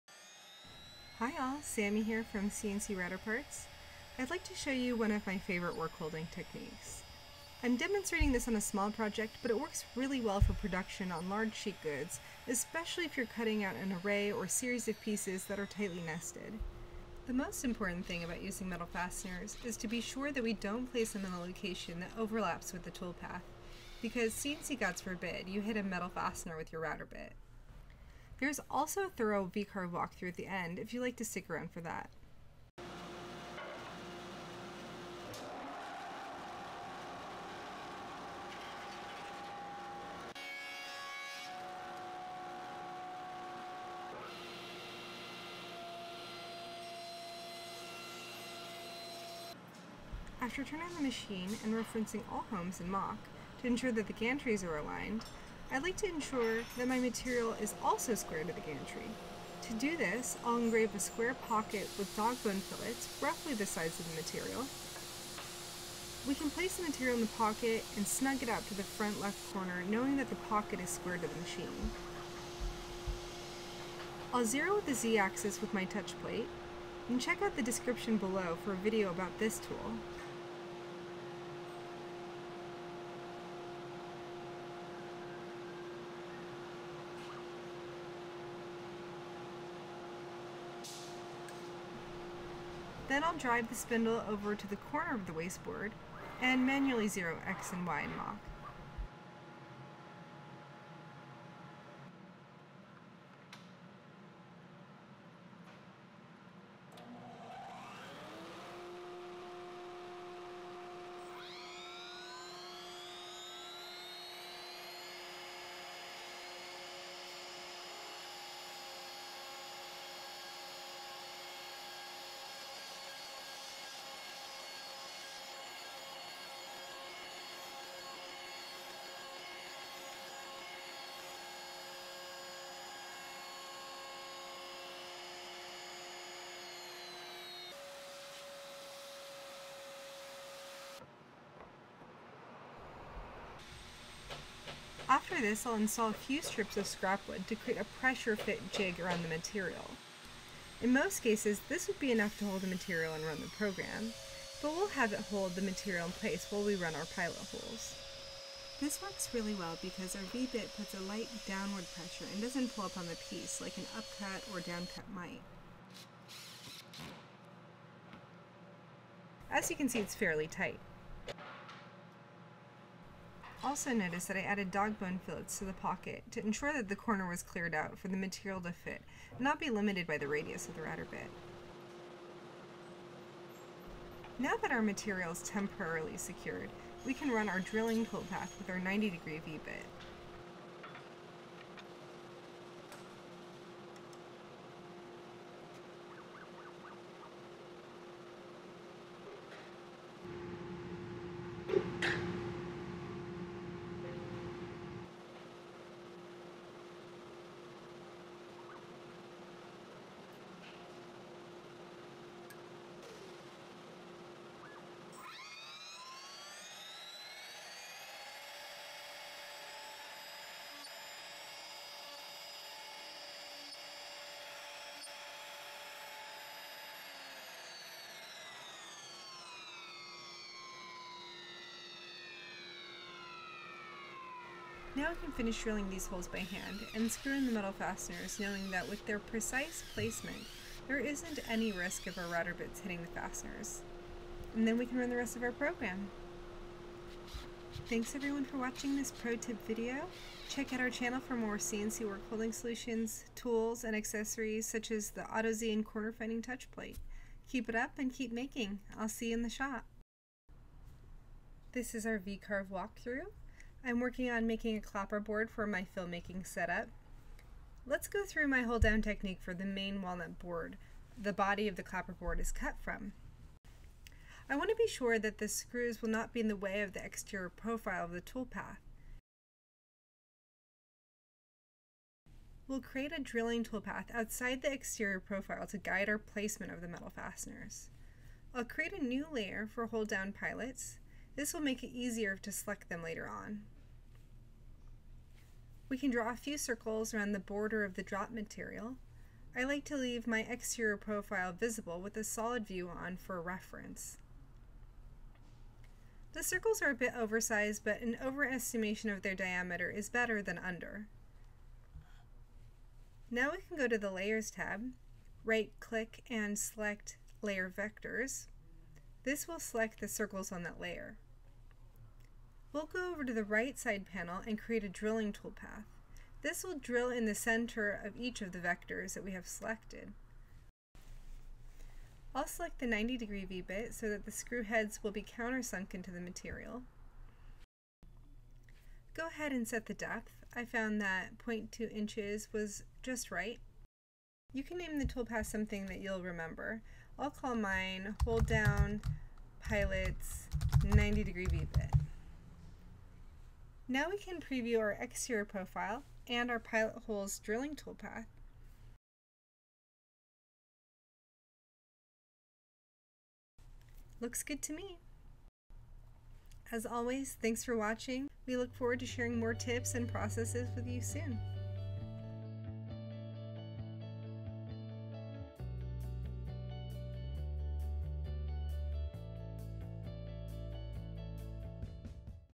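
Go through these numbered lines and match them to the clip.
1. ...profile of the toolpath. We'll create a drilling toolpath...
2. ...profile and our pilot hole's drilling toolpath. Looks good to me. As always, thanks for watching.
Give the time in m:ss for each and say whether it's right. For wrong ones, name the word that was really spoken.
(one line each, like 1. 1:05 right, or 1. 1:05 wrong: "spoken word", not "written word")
1. 4:37 right
2. 5:55 right.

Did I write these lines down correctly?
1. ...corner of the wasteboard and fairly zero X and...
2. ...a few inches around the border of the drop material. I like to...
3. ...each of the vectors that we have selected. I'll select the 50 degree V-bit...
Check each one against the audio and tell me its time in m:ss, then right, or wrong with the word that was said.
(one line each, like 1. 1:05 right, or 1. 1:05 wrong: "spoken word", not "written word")
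1. 1:34 wrong: "manually", not "fairly"
2. 4:56 wrong: "circles", not "inches"
3. 5:28 wrong: "90", not "50".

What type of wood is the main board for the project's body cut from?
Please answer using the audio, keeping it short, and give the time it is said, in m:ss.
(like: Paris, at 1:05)
walnut, at 4:30.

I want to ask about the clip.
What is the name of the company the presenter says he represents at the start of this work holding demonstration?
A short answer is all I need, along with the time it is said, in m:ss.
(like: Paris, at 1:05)
CNC Router Parts, at 0:02.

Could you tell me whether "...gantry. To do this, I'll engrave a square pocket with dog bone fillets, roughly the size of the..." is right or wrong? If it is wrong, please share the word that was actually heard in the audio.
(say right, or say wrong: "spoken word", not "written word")
right.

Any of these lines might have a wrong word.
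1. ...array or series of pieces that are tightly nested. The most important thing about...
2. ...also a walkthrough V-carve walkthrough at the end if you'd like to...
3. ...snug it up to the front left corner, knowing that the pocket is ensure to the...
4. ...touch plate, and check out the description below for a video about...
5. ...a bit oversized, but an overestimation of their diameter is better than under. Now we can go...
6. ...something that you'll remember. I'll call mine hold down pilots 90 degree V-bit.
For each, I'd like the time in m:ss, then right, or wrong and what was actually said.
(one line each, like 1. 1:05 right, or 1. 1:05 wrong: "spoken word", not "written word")
1. 0:14 right
2. 0:28 wrong: "thorough", not "walkthrough"
3. 1:08 wrong: "square", not "ensure"
4. 1:15 right
5. 5:06 right
6. 5:45 right.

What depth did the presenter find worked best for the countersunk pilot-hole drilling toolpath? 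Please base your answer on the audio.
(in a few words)
0.2 inches.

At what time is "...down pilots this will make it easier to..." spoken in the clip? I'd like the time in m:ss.
4:50.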